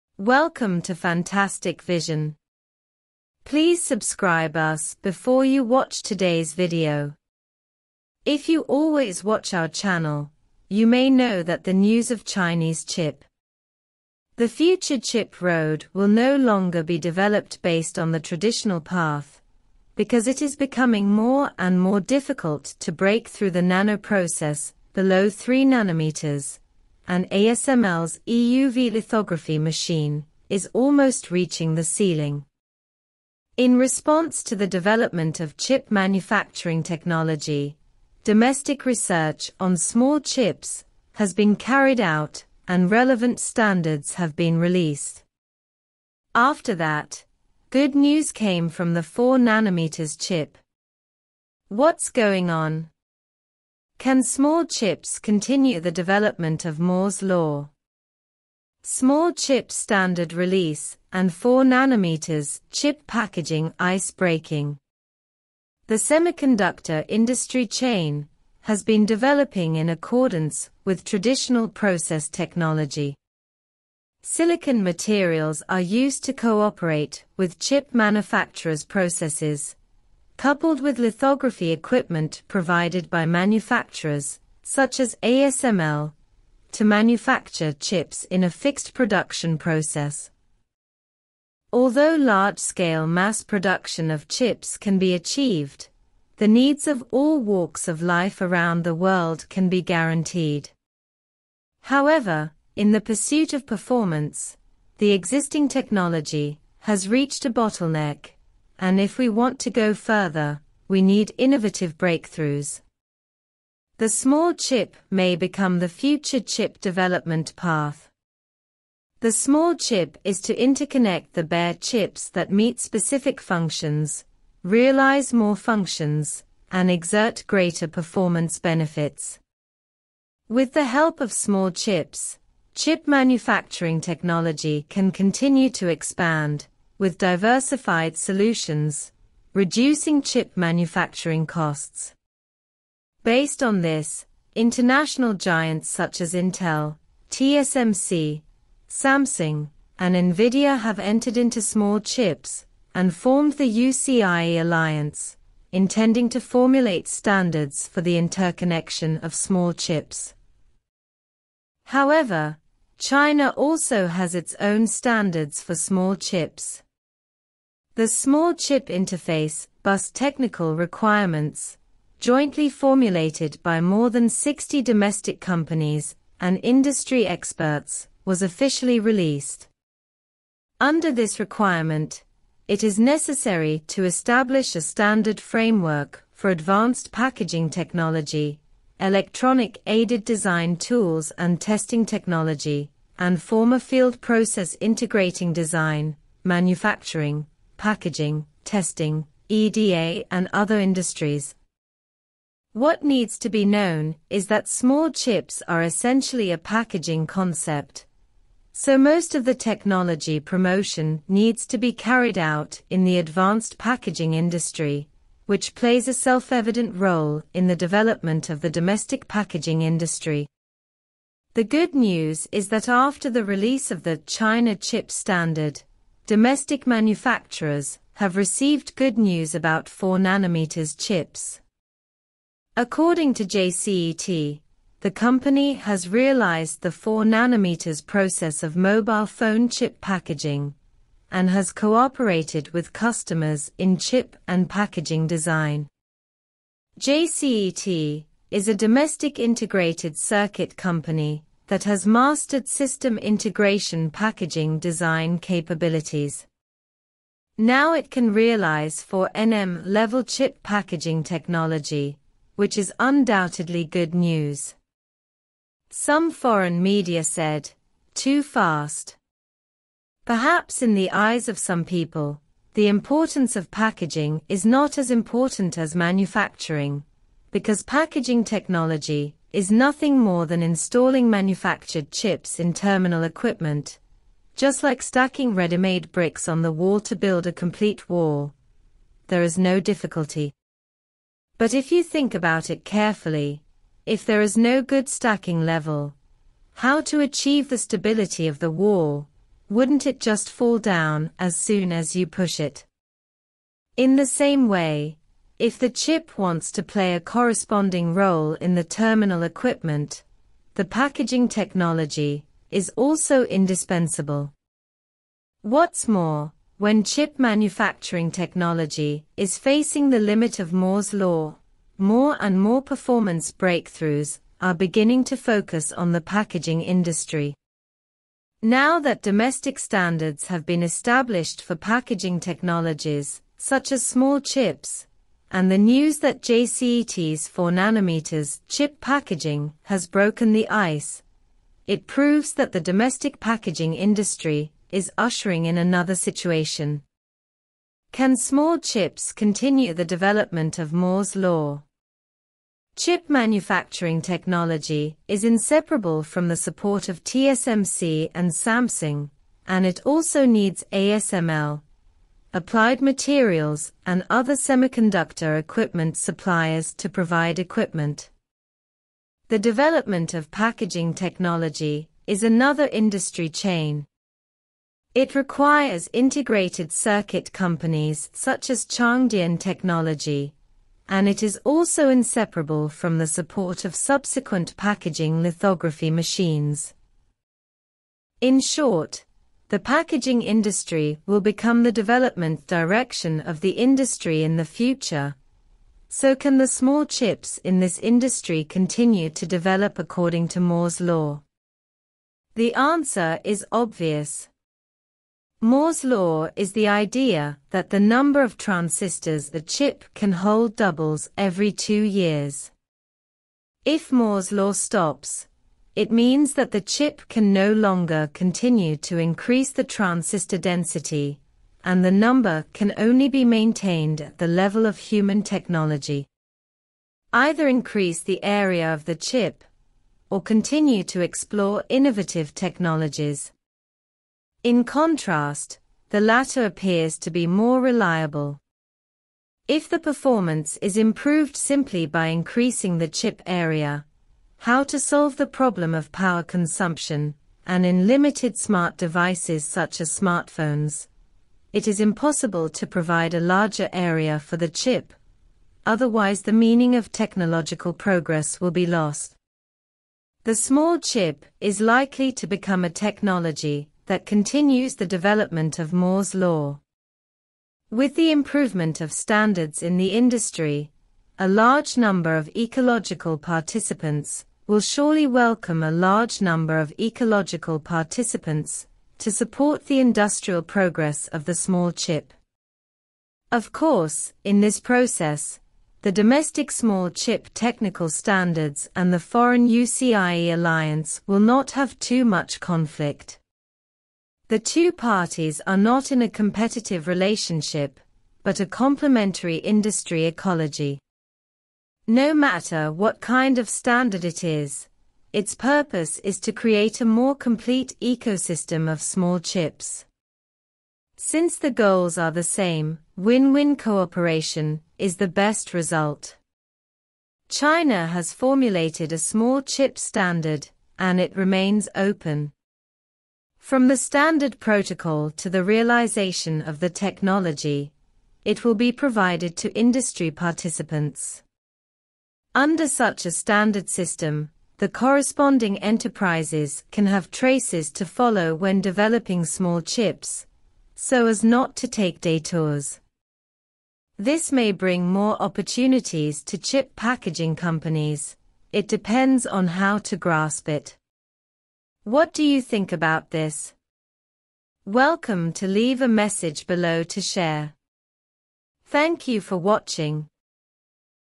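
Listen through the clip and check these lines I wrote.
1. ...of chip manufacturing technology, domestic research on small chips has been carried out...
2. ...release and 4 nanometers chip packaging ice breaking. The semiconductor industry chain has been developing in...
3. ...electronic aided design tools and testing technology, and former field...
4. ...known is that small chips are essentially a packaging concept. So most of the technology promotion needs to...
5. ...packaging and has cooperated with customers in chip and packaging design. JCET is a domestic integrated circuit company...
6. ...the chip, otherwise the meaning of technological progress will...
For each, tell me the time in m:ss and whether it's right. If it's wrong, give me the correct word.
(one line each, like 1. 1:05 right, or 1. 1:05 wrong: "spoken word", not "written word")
1. 0:35 right
2. 1:00 right
3. 3:09 right
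4. 3:23 right
5. 3:59 right
6. 7:34 right.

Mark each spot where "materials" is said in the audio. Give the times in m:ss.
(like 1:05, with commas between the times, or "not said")
1:14, 6:03.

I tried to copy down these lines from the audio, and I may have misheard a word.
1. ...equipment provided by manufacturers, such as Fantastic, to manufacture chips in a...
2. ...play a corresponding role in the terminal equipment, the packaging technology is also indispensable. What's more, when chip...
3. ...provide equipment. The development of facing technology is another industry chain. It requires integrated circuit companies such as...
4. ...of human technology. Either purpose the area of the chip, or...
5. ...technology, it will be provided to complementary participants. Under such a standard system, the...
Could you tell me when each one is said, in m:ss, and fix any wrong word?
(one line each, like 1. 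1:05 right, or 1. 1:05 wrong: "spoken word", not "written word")
1. 1:21 wrong: "ASML", not "Fantastic"
2. 5:06 right
3. 6:07 wrong: "packaging", not "facing"
4. 7:04 wrong: "increase", not "purpose"
5. 8:46 wrong: "industry", not "complementary".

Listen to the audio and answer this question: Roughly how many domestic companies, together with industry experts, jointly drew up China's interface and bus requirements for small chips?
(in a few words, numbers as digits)
more than 60.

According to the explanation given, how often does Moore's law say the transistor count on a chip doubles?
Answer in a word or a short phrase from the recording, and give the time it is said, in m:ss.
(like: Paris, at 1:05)
every 2 years, at 6:51.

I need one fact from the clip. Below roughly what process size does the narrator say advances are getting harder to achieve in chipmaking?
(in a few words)
3 nanometers.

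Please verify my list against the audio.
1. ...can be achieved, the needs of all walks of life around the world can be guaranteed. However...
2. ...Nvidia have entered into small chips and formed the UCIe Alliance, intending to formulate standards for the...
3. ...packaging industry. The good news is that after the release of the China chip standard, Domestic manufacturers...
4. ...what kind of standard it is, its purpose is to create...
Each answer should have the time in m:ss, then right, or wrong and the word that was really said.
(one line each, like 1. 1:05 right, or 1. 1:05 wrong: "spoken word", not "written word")
1. 1:34 right
2. 2:30 right
3. 3:39 right
4. 8:22 right.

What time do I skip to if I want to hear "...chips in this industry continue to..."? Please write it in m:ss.
6:37.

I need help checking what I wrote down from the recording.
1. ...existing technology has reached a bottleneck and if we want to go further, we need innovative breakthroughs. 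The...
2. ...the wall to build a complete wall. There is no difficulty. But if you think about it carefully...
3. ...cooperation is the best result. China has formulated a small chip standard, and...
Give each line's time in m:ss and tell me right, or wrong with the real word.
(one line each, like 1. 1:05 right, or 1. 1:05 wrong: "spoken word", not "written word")
1. 1:45 right
2. 4:46 right
3. 8:33 right.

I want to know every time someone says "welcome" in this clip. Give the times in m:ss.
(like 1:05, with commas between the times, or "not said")
0:00, 7:55, 9:14.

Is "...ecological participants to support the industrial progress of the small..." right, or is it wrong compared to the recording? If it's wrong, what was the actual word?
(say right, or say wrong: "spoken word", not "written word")
right.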